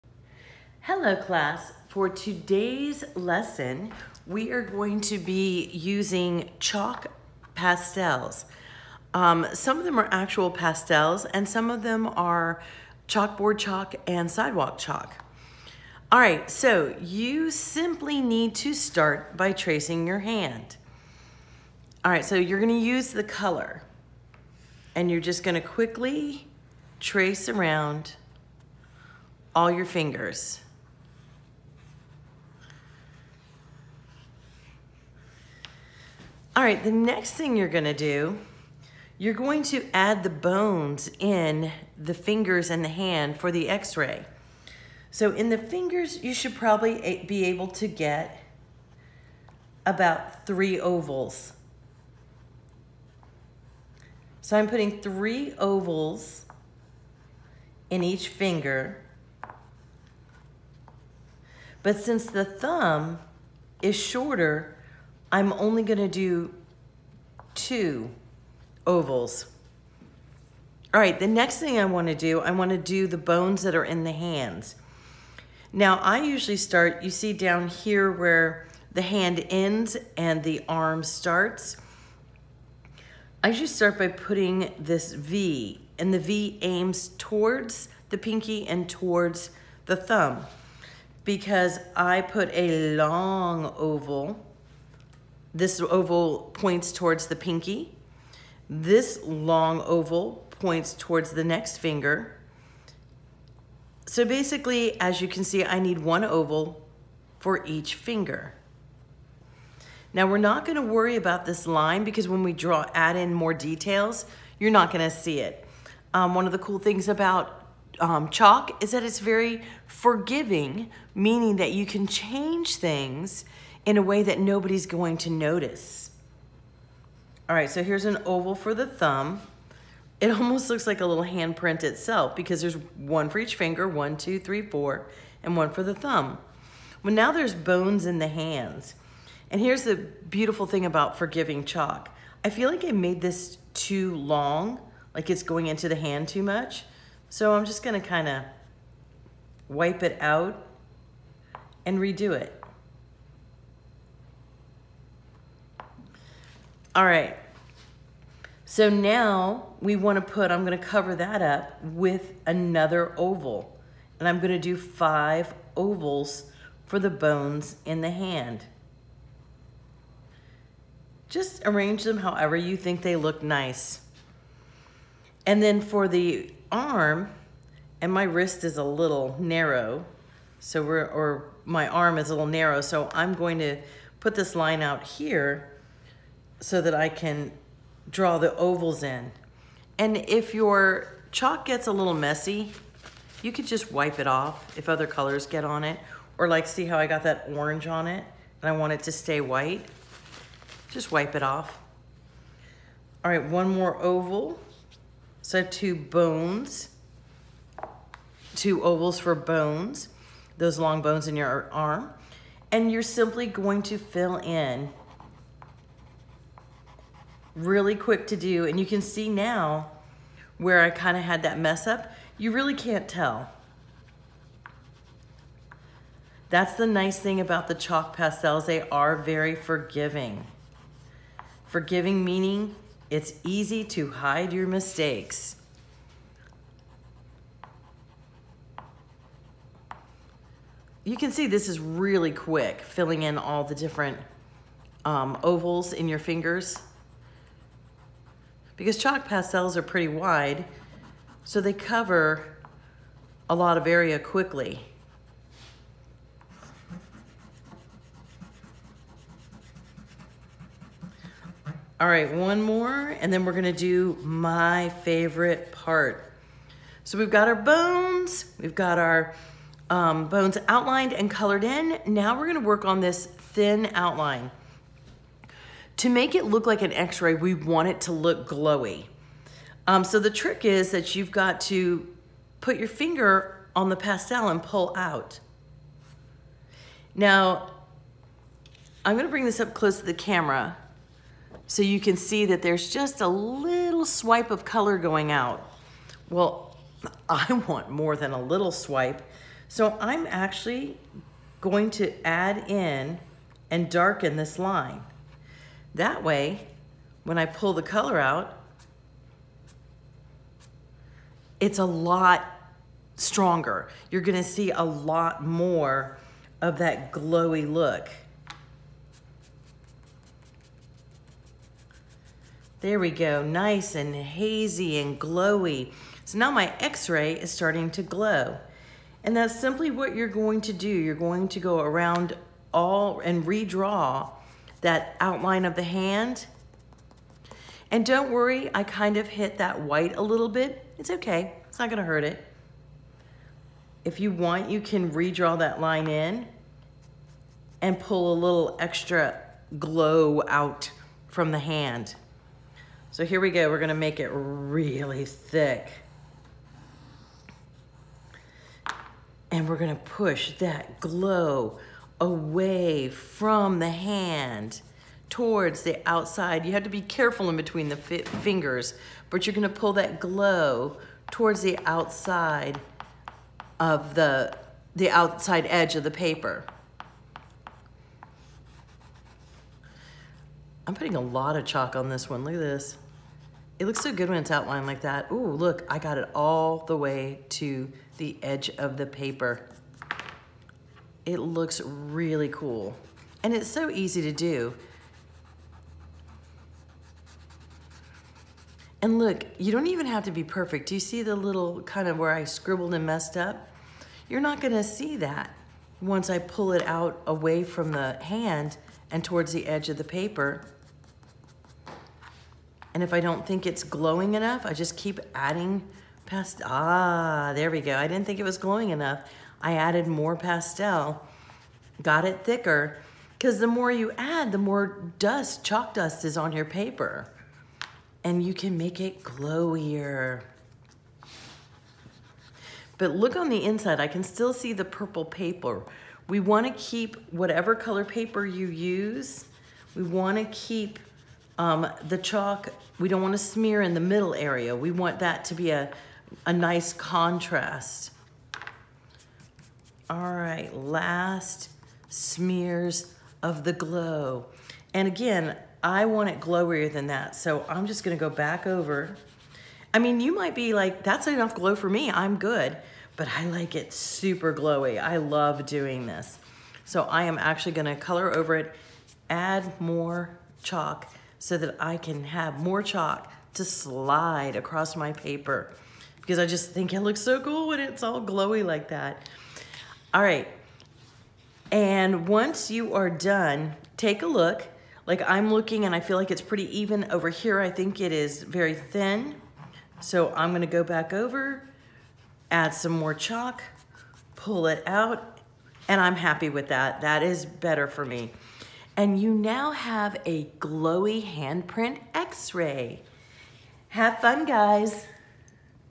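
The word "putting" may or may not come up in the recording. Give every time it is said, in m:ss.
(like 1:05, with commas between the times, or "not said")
0:54, 1:24, 6:20.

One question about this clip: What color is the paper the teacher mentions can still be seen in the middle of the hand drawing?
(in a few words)
purple.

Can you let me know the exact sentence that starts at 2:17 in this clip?
Well, now there's bones in the hands.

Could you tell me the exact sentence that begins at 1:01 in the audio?
But since the thumb is shorter I'm only gonna do two ovals.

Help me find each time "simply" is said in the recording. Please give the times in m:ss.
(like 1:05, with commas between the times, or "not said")
0:17, 3:33, 5:29.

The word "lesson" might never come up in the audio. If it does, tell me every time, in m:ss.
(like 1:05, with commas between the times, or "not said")
0:03.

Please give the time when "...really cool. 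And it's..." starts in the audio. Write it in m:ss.
6:31.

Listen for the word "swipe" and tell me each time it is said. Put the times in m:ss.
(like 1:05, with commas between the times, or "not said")
4:54, 4:58.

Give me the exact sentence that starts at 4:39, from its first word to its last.
Um, so the trick is that you've got to put your finger on the pastel and pull out.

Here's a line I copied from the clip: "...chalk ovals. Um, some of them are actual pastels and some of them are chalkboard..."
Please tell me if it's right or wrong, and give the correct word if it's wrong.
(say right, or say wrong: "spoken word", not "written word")
wrong: "pastels", not "ovals".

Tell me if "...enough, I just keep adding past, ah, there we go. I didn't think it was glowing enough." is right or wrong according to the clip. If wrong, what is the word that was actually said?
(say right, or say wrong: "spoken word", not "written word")
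right.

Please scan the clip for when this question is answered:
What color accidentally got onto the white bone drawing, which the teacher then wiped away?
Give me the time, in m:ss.
3:17.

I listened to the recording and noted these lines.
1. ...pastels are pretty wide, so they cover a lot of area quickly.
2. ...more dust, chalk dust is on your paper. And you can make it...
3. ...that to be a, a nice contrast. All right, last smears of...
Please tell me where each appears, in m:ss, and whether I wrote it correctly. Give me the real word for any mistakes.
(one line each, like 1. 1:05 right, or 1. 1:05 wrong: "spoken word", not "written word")
1. 4:09 right
2. 7:04 right
3. 7:25 right.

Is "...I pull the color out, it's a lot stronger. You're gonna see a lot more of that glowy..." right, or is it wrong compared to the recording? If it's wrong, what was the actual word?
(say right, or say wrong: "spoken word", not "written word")
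right.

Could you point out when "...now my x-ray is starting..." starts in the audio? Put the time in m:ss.
5:26.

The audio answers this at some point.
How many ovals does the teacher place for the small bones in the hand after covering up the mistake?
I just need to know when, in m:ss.
2:44.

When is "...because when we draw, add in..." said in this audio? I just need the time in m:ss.
1:52.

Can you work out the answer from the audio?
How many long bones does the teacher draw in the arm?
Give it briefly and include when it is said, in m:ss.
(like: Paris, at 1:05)
2, at 3:28.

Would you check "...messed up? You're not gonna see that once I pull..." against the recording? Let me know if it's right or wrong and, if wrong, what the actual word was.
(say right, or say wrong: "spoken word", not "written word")
right.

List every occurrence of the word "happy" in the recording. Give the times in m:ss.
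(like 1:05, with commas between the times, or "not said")
8:16.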